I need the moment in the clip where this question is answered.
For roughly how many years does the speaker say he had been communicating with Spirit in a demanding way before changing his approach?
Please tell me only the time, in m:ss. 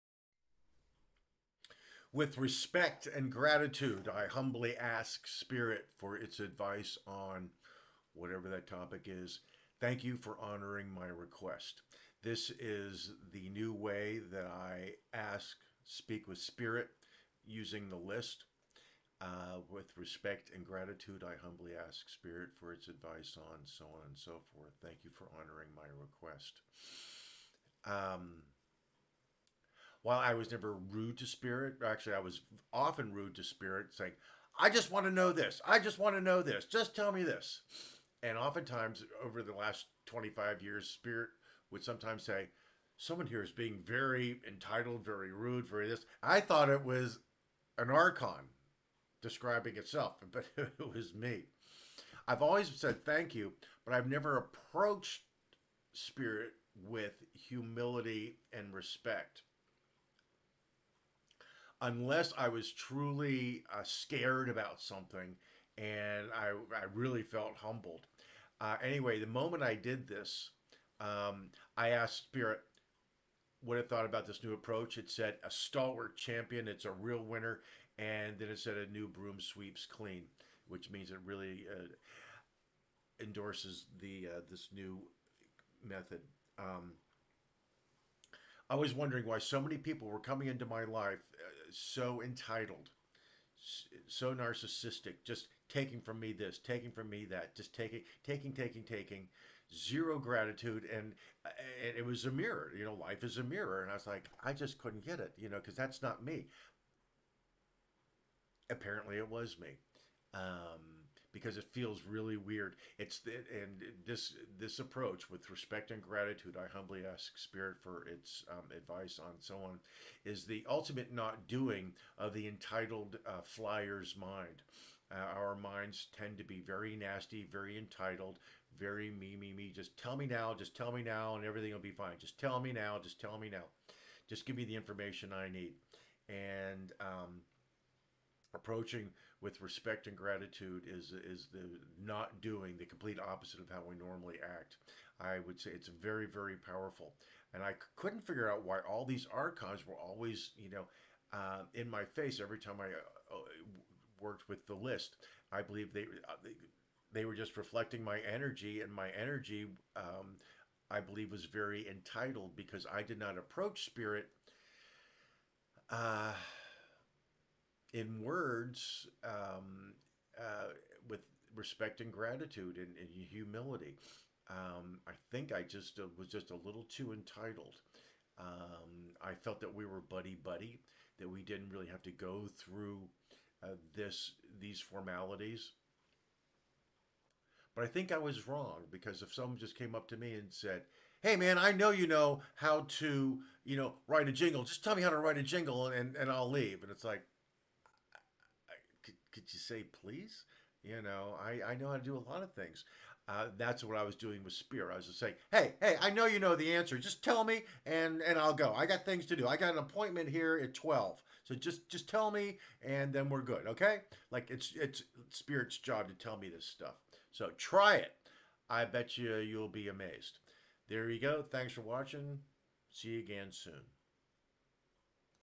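0:40.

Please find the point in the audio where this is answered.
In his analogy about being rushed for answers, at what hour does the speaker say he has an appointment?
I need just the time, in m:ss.
3:30.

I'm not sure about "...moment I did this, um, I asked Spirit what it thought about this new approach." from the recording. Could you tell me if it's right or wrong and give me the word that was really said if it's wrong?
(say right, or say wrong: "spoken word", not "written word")
right.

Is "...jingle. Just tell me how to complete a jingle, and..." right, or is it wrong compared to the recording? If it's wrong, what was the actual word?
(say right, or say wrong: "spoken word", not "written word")
wrong: "write", not "complete".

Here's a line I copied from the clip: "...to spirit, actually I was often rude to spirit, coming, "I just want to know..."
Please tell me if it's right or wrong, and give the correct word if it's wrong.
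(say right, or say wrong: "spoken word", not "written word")
wrong: "saying", not "coming".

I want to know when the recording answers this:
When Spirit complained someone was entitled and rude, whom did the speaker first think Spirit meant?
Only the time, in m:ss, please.
0:47.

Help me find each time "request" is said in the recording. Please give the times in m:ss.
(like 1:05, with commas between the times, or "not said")
0:11, 0:25.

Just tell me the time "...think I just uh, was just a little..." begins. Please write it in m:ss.
2:55.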